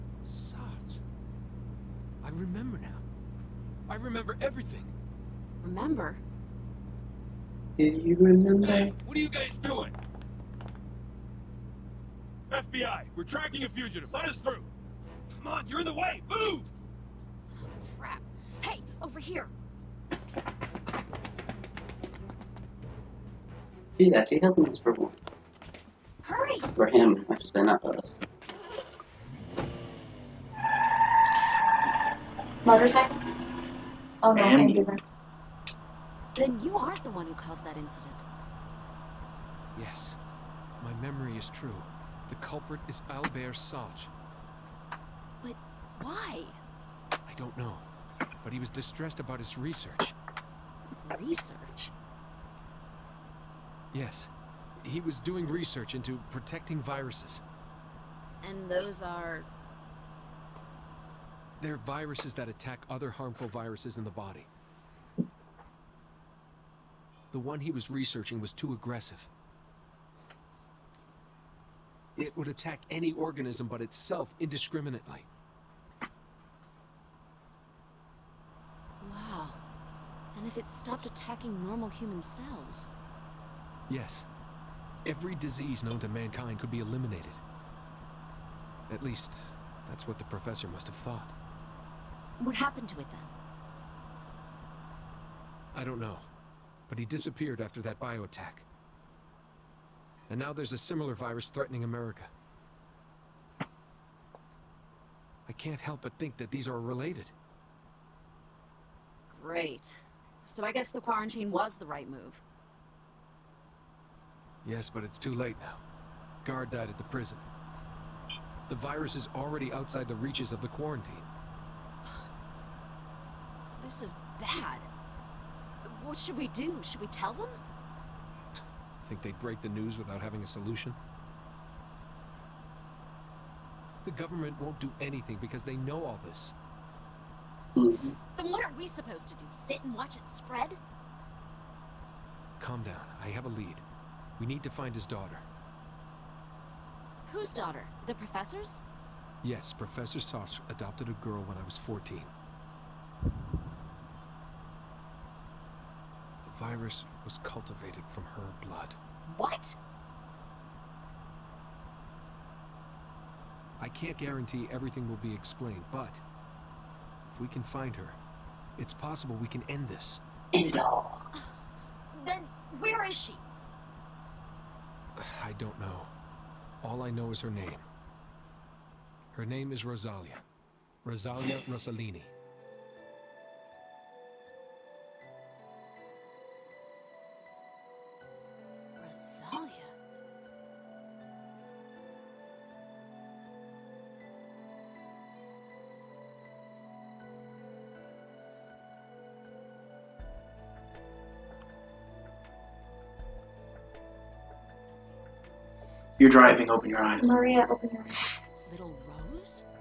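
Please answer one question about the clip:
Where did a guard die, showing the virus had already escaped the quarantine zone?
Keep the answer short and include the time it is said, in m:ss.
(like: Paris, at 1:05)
The prison, at 1:57.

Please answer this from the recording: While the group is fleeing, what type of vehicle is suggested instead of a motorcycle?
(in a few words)
Ambulance.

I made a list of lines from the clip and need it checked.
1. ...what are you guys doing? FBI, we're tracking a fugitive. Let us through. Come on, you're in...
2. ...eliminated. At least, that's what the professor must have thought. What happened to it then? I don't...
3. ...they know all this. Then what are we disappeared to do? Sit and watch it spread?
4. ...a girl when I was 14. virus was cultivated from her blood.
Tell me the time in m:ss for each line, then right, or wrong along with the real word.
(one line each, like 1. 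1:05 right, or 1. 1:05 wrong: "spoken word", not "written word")
1. 0:09 right
2. 1:26 right
3. 2:15 wrong: "supposed", not "disappeared"
4. 2:31 right.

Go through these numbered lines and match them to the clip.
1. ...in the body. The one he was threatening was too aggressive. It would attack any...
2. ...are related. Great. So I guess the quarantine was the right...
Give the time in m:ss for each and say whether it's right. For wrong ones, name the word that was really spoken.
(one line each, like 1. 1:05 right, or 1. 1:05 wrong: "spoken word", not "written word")
1. 1:03 wrong: "researching", not "threatening"
2. 1:46 right.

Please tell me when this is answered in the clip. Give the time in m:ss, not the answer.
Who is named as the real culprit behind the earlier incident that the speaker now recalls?
0:43.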